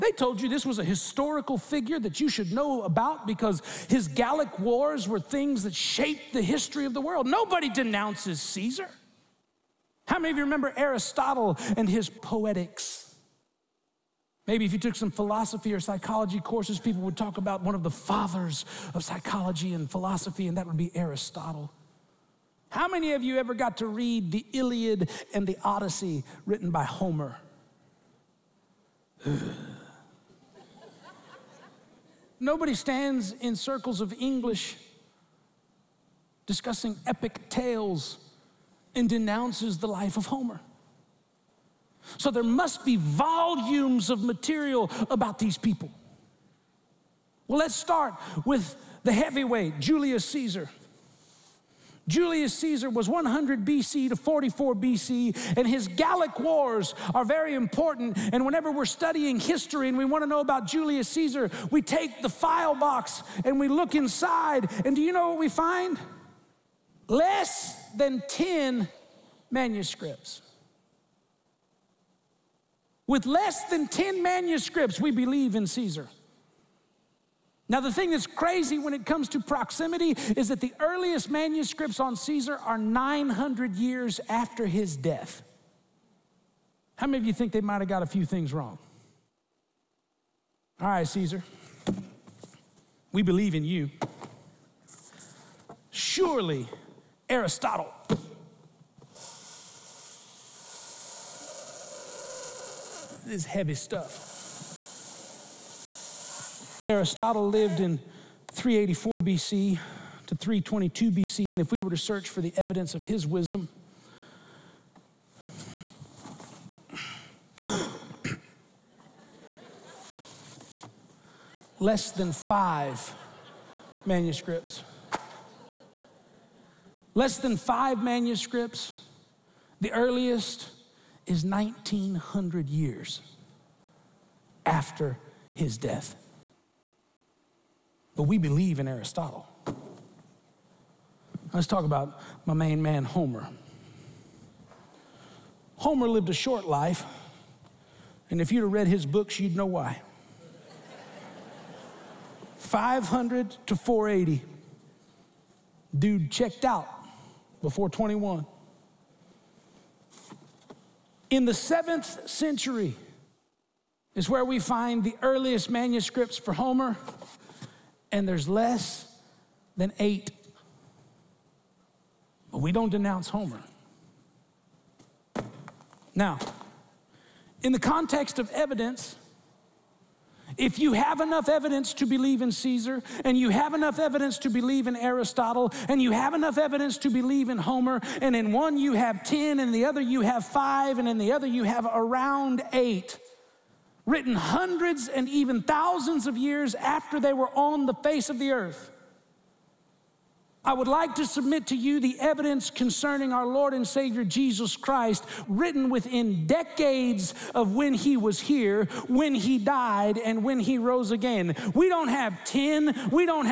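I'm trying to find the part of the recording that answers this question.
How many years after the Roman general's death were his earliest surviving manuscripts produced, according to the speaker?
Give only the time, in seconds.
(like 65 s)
82 s.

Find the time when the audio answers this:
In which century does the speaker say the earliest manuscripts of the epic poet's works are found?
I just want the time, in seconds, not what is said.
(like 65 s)
161 s.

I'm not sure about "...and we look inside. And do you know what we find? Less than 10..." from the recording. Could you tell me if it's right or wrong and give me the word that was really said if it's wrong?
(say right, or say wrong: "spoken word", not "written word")
right.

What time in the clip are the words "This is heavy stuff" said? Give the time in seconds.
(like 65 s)
103 s.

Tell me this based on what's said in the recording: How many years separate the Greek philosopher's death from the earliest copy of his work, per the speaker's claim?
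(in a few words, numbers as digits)
1900.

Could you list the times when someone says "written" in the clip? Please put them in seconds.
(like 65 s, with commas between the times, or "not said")
26 s, 194 s, 205 s.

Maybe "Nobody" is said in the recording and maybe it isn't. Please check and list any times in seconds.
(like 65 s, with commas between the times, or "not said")
7 s, 32 s.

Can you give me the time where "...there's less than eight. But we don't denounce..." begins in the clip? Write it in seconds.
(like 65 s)
168 s.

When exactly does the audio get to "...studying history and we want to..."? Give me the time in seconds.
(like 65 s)
58 s.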